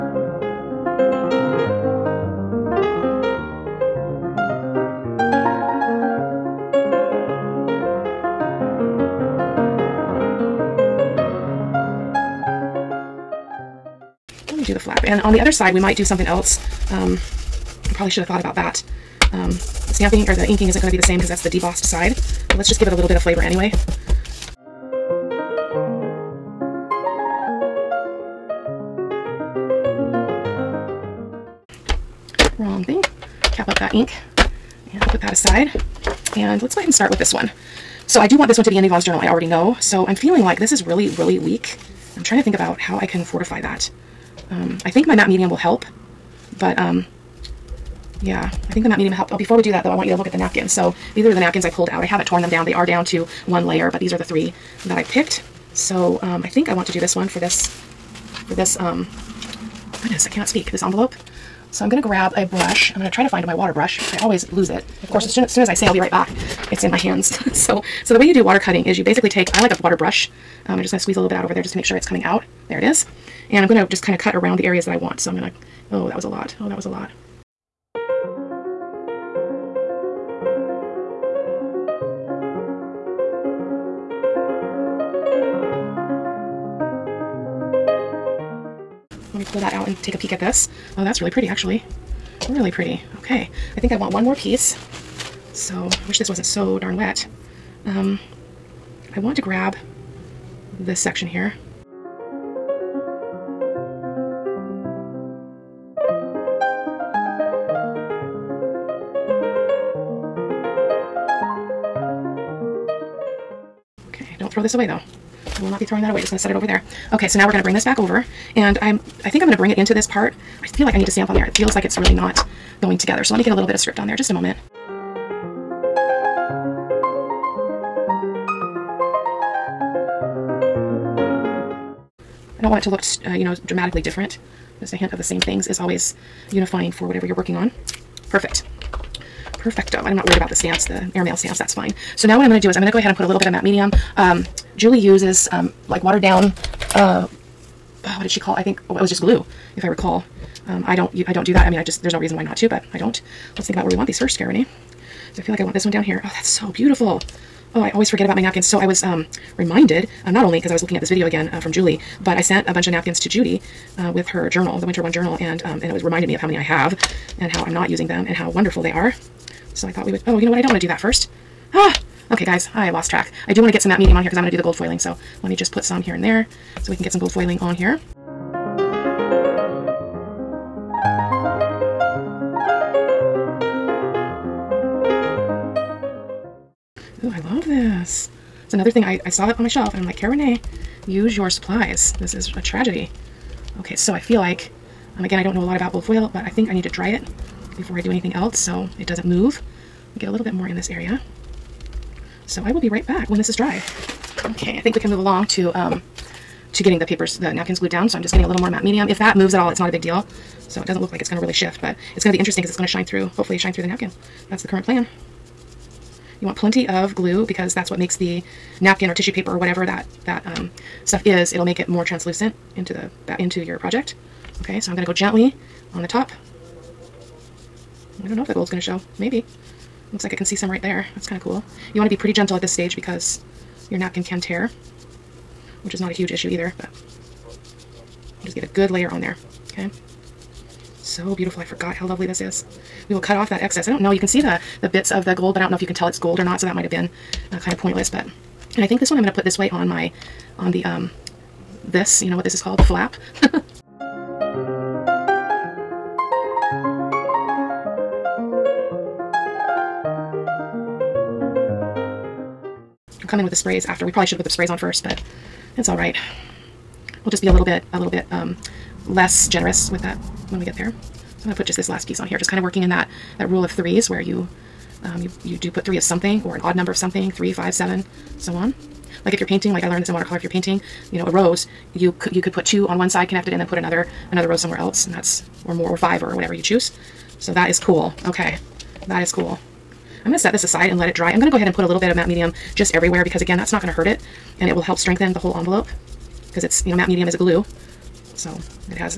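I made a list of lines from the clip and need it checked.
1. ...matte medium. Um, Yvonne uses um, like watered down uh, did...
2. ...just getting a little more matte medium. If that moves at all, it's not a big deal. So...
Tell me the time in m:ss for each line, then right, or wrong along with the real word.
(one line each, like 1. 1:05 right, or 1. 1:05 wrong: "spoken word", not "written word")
1. 2:23 wrong: "Julie", not "Yvonne"
2. 3:28 right.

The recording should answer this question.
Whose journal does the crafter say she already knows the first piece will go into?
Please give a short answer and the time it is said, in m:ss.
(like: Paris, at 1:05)
Yvonne's, at 0:38.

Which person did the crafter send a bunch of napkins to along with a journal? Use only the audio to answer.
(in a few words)
Judy.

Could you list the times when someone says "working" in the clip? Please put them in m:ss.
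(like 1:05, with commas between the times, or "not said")
2:17, 4:32.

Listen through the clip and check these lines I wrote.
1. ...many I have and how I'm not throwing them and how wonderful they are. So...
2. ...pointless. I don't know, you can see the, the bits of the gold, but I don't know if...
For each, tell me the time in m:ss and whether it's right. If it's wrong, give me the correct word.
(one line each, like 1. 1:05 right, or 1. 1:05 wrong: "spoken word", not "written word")
1. 2:46 wrong: "using", not "throwing"
2. 4:03 wrong: "excess", not "pointless".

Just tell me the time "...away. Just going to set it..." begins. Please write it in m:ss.
1:56.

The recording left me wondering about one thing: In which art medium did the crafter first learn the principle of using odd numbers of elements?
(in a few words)
Watercolor.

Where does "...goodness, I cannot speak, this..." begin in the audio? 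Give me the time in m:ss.
1:00.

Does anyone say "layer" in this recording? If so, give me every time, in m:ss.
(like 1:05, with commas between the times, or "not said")
0:53, 3:58.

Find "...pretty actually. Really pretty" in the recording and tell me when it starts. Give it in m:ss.
1:31.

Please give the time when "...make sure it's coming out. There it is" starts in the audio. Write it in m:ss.
1:11.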